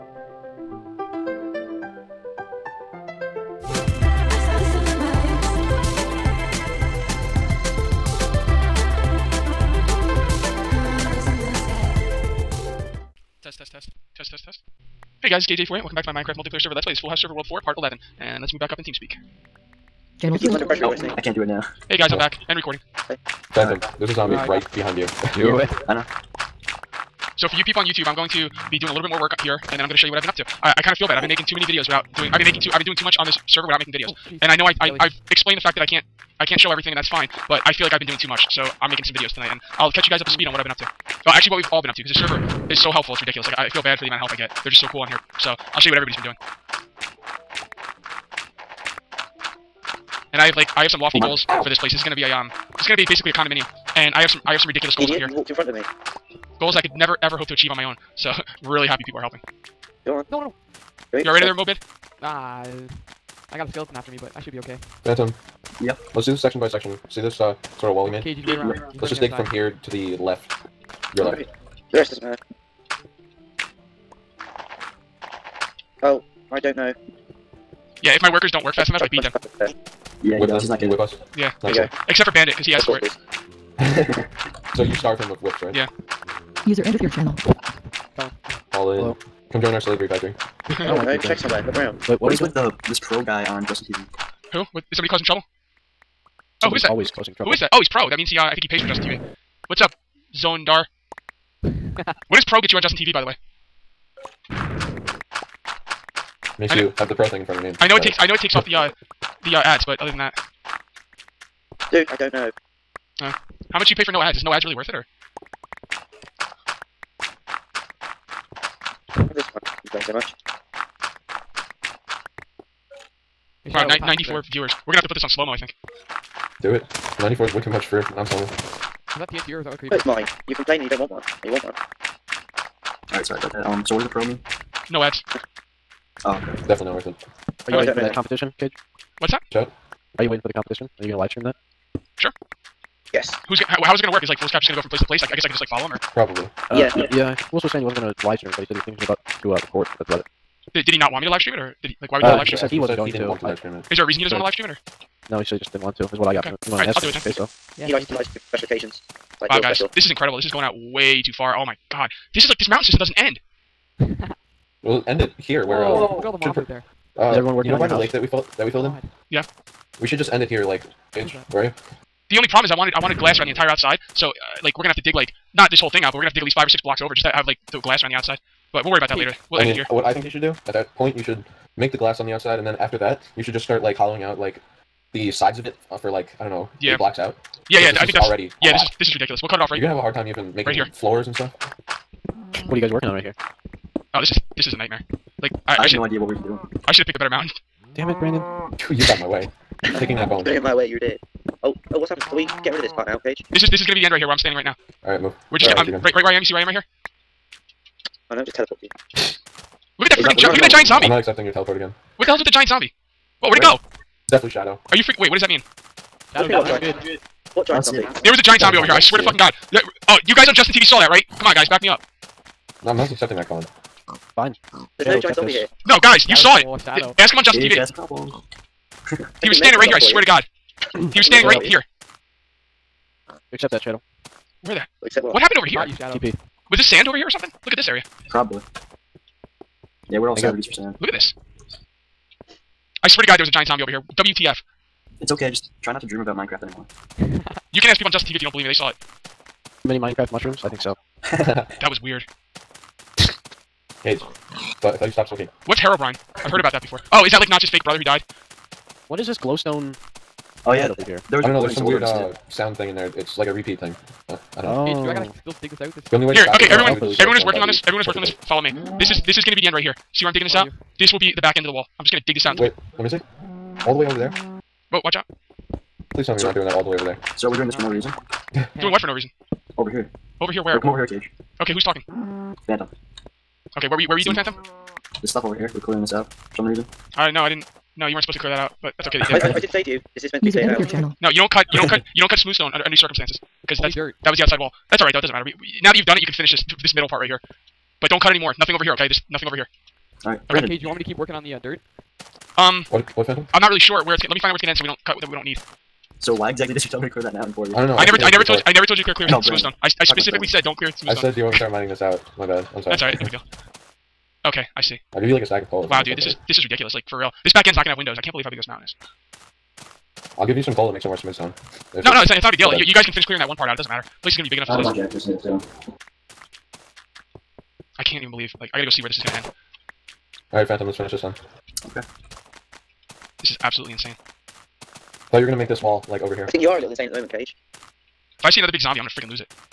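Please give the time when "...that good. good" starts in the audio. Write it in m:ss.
3:36.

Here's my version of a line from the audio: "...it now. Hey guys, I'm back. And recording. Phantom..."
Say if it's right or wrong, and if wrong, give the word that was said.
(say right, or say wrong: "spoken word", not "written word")
right.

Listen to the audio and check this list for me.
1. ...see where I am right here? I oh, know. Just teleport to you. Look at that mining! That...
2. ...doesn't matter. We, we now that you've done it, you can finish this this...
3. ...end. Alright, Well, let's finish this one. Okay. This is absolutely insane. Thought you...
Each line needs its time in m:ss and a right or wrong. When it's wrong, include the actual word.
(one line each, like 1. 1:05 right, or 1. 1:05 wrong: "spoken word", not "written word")
1. 3:26 wrong: "freaking", not "mining"
2. 4:55 right
3. 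5:29 wrong: "Phantom", not "Well".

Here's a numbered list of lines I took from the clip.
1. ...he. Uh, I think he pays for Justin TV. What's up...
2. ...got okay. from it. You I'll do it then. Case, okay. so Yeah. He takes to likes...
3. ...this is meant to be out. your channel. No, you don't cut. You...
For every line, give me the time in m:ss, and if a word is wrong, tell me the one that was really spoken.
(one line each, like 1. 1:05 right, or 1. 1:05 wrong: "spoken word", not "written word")
1. 1:38 right
2. 2:36 wrong: "likes", not "takes"
3. 4:50 right.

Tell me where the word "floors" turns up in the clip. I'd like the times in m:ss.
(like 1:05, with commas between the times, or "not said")
3:10.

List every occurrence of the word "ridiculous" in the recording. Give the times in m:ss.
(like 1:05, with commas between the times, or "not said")
0:43, 0:54, 3:09, 5:16.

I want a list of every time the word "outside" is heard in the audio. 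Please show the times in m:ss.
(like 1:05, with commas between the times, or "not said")
2:53, 2:58, 3:02, 4:54.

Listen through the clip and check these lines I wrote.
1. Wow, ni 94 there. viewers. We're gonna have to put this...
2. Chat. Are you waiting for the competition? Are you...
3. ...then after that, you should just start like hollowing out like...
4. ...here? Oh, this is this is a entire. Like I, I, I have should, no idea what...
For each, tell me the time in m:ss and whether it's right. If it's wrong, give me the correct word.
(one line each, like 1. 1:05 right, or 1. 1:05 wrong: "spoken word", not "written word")
1. 2:03 right
2. 2:19 right
3. 3:02 right
4. 3:13 wrong: "nightmare", not "entire".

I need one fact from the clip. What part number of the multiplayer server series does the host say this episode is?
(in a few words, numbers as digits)
Part 11.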